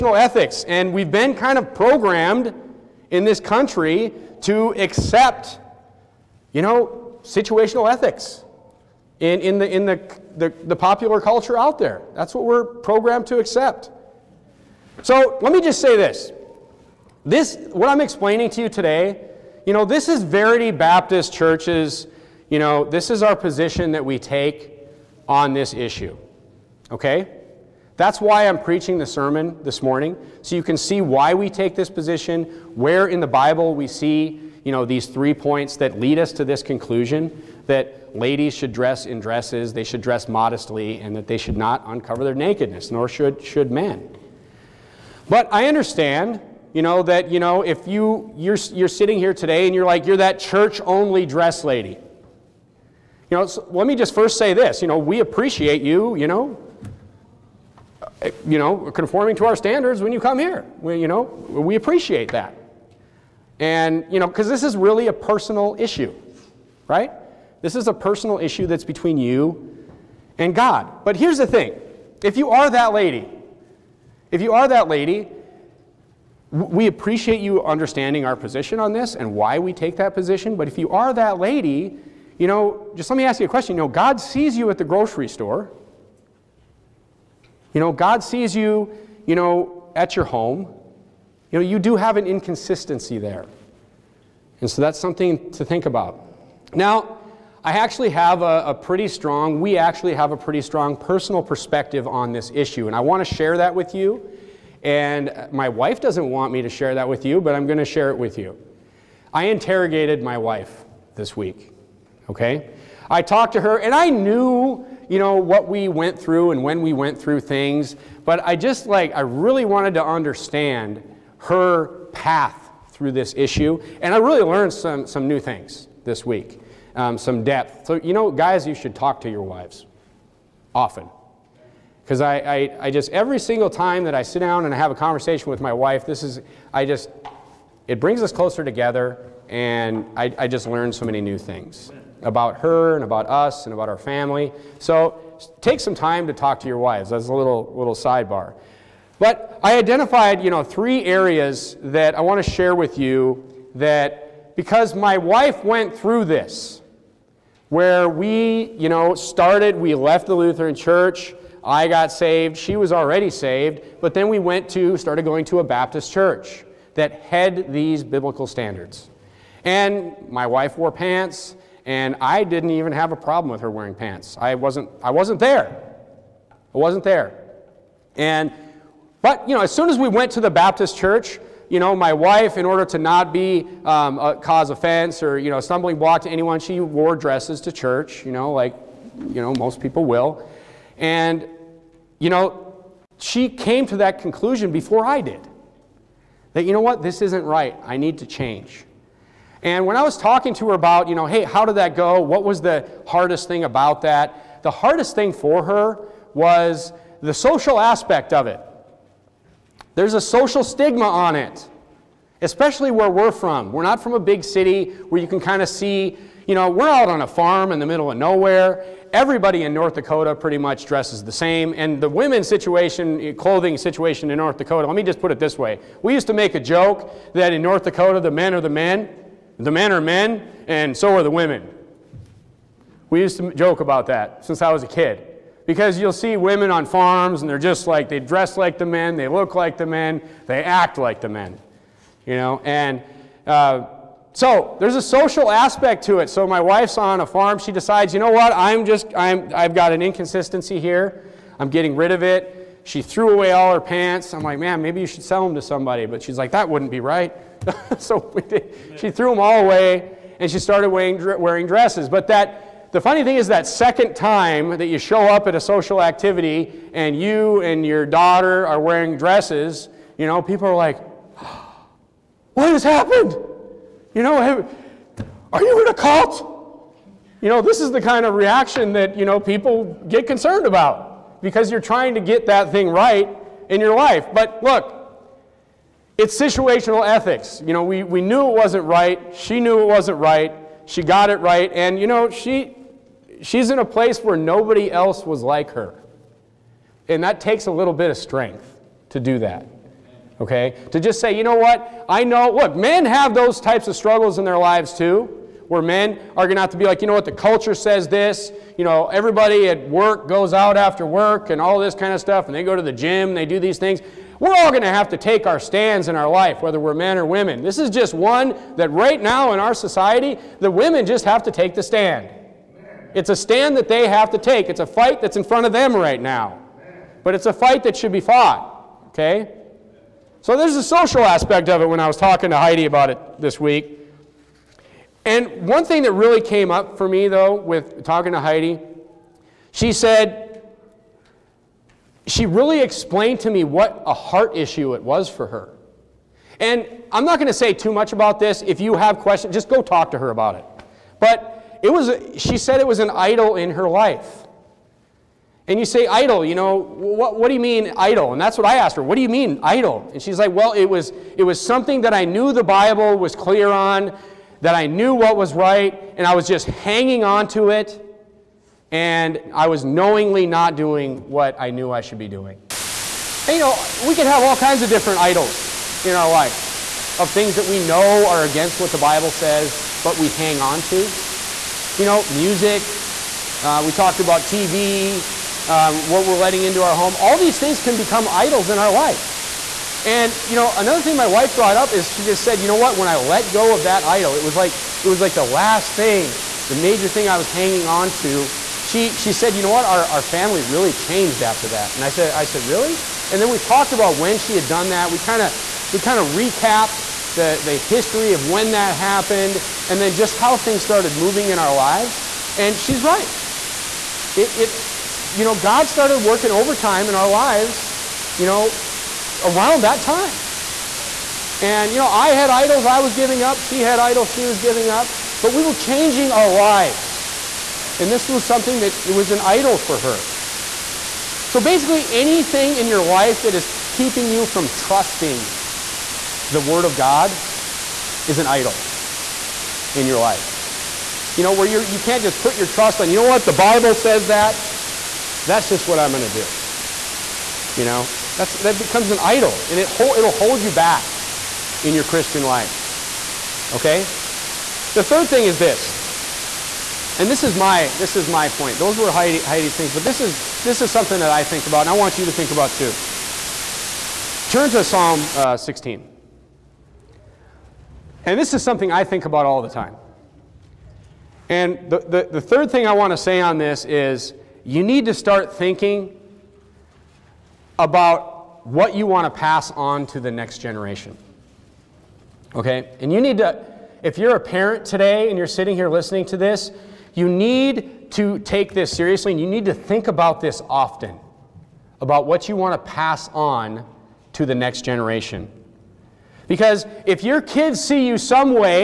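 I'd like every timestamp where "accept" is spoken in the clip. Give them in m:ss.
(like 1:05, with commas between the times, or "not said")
0:04, 0:13.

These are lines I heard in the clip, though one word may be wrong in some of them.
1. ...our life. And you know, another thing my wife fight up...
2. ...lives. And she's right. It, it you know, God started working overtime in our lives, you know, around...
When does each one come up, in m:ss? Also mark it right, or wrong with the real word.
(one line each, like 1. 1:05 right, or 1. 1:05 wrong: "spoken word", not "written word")
1. 6:28 wrong: "brought", not "fight"
2. 6:51 right.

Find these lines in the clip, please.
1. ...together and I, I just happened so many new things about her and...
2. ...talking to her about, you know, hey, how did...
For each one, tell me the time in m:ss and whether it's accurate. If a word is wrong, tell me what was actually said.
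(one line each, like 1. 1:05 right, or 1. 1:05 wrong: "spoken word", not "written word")
1. 2:18 wrong: "learned", not "happened"
2. 3:20 right.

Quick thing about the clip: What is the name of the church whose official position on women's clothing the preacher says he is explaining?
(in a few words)
Verity Baptist Church.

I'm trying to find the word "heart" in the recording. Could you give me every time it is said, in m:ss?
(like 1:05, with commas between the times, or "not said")
5:44.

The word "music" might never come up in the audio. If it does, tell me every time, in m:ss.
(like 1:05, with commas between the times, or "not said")
6:22.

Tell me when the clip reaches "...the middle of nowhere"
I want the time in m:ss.
3:37.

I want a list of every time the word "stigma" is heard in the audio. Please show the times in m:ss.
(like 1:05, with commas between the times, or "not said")
3:30.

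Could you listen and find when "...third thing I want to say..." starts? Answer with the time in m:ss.
7:52.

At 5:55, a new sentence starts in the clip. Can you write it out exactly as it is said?
And you say idol, you know, what, what do you mean idol?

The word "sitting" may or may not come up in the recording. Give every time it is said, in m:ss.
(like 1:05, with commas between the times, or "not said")
0:48, 8:05.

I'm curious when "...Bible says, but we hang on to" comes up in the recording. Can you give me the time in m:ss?
6:18.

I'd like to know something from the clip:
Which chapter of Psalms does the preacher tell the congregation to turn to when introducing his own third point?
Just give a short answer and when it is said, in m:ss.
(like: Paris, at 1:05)
Psalm 16, at 7:44.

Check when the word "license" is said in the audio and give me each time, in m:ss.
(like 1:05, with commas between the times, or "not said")
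not said.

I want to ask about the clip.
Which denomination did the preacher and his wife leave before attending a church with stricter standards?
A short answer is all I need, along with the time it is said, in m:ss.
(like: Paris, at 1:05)
Lutheran, at 2:40.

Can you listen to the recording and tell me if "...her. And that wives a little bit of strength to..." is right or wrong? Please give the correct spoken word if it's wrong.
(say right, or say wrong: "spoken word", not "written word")
wrong: "takes", not "wives".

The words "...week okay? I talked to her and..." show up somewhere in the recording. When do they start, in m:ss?
1:51.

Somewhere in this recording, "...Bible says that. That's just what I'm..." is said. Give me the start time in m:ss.
7:23.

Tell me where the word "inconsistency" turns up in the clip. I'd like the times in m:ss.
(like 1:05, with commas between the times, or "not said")
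1:32, 4:10.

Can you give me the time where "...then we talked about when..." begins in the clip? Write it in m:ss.
6:43.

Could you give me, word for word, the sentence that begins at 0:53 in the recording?
You know, so let me just first say this.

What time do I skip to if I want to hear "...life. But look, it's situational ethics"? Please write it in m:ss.
4:43.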